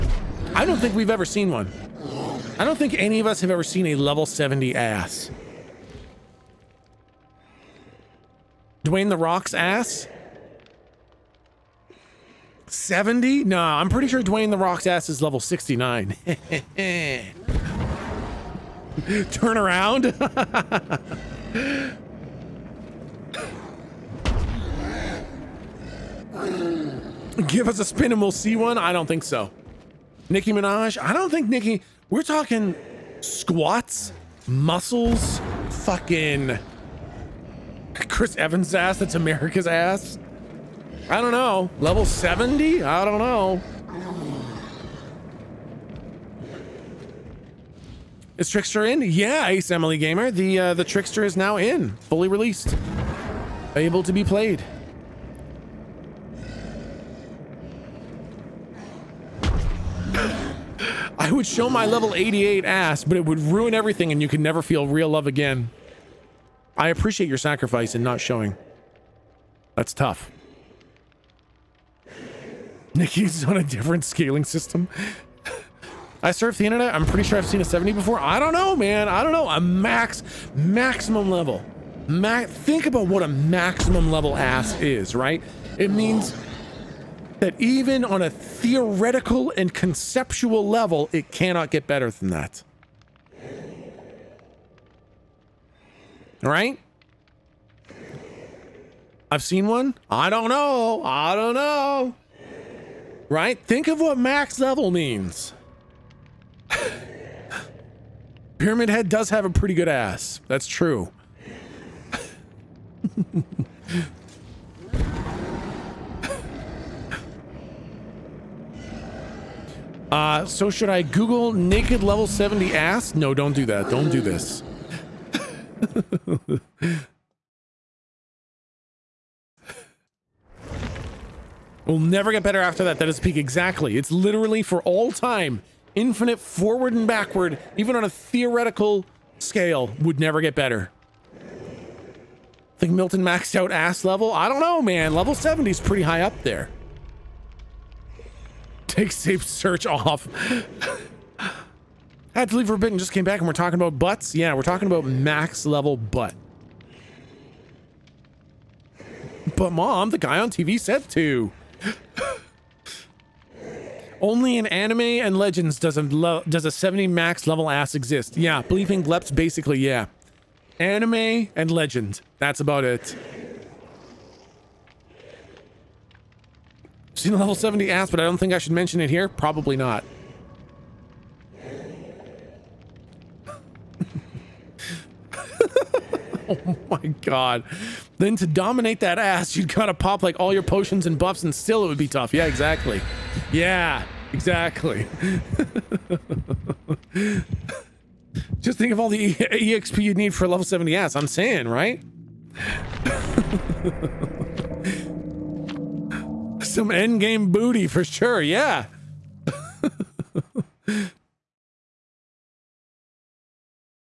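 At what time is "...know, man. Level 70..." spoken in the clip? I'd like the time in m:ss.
2:24.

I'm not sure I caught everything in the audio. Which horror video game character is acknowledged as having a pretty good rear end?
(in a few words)
Pyramid Head.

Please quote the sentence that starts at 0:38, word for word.
Chris Evans' ass, that's America's ass.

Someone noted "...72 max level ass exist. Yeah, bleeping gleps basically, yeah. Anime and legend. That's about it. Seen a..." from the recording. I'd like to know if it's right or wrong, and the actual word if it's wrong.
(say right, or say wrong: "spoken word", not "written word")
wrong: "70", not "72".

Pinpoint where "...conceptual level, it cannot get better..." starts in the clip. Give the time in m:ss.
1:29.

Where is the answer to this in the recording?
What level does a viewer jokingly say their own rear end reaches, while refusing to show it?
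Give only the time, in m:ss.
1:02.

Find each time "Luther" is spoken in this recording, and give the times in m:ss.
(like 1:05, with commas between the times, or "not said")
not said.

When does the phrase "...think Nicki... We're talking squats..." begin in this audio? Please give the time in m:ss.
0:31.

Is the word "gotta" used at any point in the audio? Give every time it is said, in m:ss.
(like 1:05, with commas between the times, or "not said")
3:09.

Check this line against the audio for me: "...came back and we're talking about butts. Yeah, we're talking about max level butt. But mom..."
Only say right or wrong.
right.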